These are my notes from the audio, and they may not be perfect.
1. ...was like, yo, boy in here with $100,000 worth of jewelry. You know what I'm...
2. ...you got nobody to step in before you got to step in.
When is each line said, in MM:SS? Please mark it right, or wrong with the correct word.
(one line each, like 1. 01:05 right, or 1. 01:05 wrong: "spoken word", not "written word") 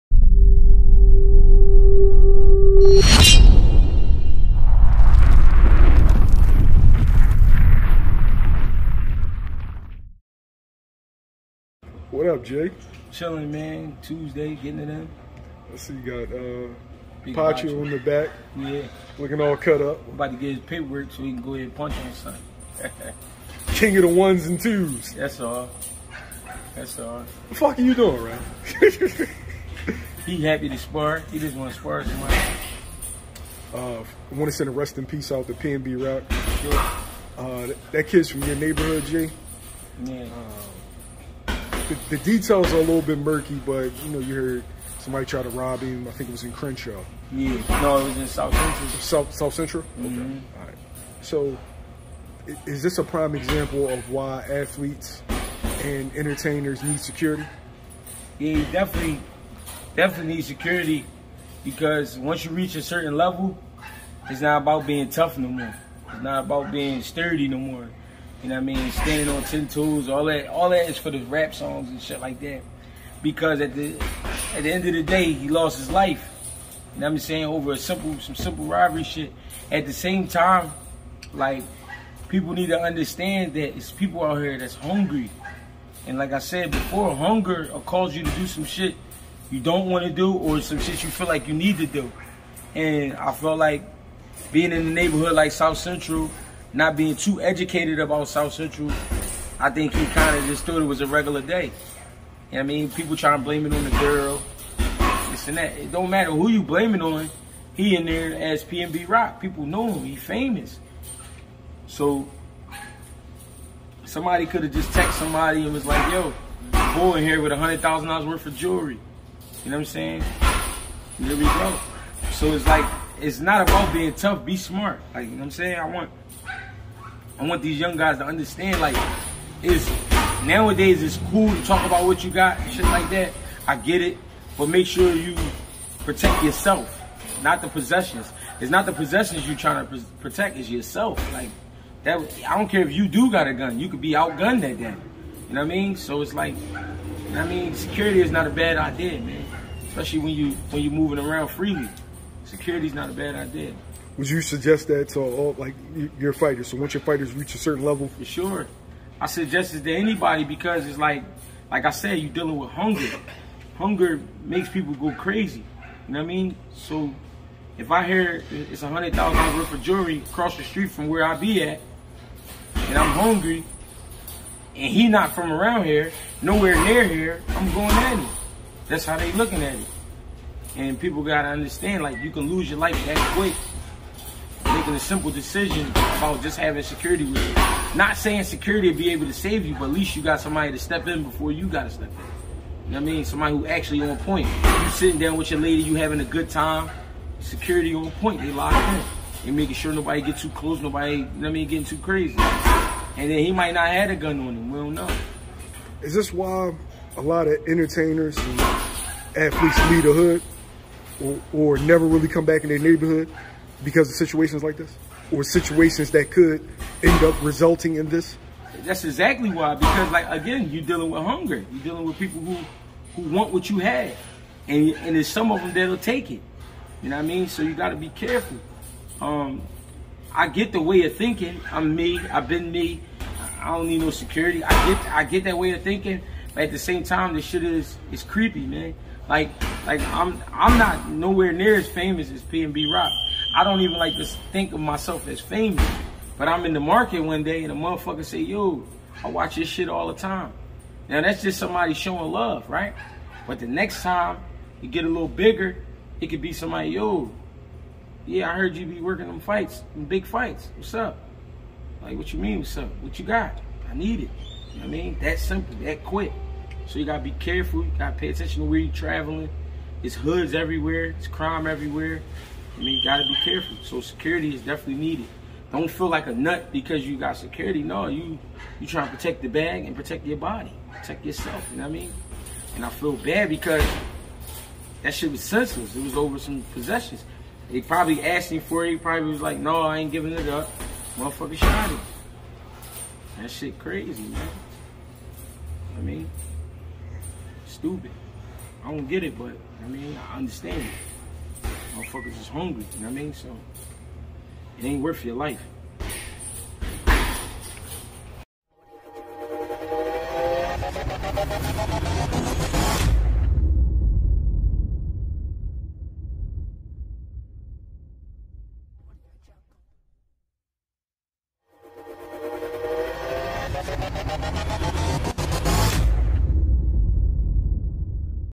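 1. 01:55 right
2. 03:10 wrong: "somebody", not "nobody".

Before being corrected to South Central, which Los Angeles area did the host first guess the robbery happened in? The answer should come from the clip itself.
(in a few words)
Crenshaw.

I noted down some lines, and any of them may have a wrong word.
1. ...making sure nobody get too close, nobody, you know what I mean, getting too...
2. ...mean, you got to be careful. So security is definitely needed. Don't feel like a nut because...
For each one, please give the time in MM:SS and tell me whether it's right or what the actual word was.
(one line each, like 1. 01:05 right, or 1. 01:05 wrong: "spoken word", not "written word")
1. 03:19 right
2. 04:32 right.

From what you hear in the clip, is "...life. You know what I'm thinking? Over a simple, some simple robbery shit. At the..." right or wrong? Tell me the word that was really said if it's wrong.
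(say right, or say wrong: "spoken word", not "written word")
wrong: "saying", not "thinking".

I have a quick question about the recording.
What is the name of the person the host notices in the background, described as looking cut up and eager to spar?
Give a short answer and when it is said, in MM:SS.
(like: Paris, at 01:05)
Pacho, at 00:17.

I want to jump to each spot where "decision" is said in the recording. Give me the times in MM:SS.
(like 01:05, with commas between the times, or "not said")
03:05.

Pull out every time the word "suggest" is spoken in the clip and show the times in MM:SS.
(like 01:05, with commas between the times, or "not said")
02:34, 02:39.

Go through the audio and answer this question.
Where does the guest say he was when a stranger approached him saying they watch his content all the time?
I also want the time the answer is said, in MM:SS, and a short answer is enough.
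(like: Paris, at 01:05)
the market, at 04:06.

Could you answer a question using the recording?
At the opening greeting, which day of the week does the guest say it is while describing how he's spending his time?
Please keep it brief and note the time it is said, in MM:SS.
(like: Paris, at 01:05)
Tuesday, at 00:14.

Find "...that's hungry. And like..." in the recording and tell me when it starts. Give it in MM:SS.
01:24.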